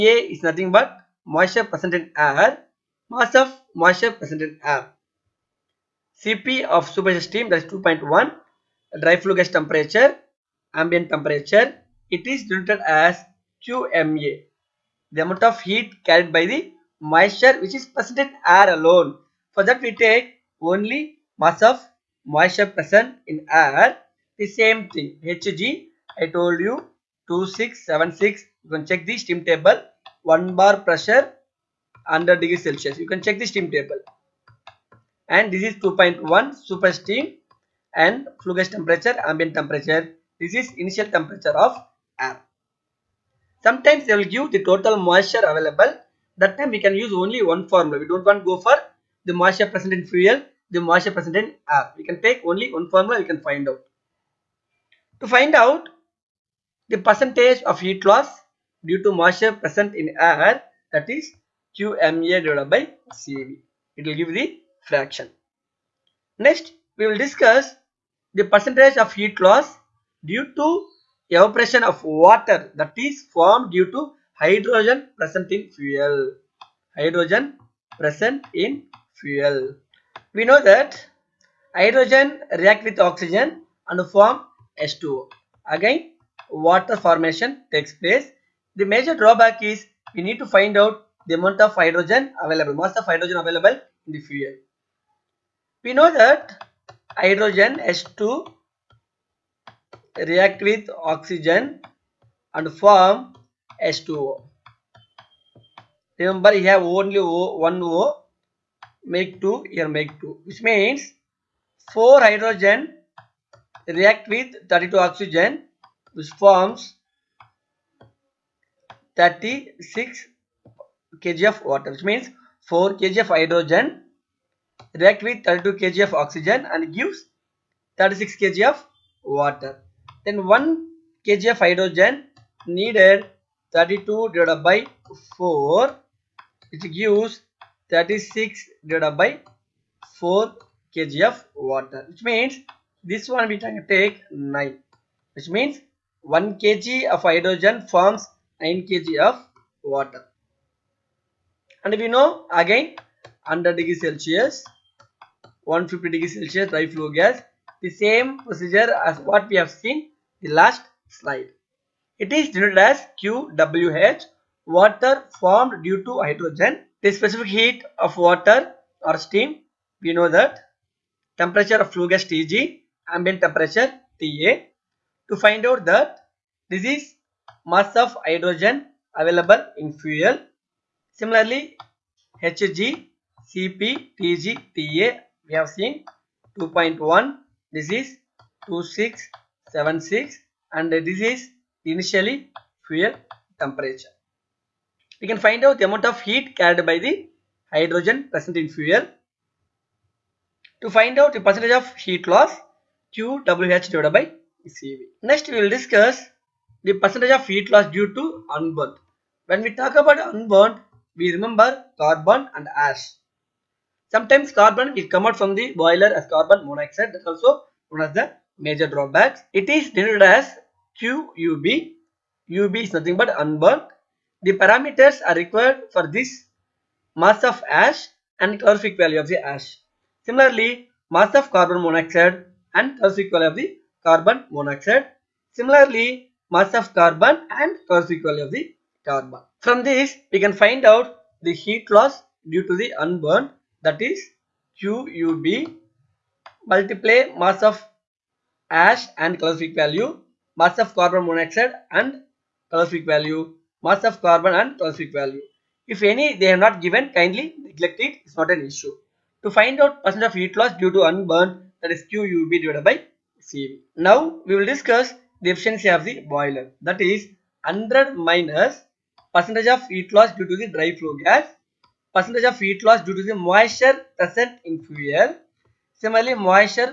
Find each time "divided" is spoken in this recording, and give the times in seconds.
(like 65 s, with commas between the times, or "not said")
62 s, 134 s, 138 s, 203 s, 262 s.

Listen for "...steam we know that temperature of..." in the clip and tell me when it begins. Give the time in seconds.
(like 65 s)
169 s.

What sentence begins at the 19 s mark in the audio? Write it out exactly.
For that we take only mass of moisture present in air.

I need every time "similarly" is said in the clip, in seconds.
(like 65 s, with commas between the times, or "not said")
181 s, 230 s, 235 s, 276 s.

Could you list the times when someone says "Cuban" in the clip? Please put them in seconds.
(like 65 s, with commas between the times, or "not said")
not said.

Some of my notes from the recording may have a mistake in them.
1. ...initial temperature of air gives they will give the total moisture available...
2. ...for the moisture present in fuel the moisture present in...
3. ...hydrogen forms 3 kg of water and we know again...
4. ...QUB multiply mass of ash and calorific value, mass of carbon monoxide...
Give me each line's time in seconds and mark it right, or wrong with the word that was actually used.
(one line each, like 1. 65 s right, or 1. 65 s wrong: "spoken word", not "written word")
1. 40 s wrong: "sometimes", not "gives"
2. 48 s right
3. 147 s wrong: "9", not "3"
4. 244 s right.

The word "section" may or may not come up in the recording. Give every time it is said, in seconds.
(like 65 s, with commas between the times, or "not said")
not said.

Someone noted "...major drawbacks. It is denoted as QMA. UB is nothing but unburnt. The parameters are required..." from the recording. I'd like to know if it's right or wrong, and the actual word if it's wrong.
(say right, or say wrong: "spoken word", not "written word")
wrong: "QUB", not "QMA".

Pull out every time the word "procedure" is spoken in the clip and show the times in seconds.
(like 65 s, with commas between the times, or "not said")
158 s.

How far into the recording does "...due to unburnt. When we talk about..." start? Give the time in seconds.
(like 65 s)
207 s.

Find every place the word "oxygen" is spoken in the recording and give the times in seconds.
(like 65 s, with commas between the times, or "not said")
82 s, 101 s, 114 s, 126 s.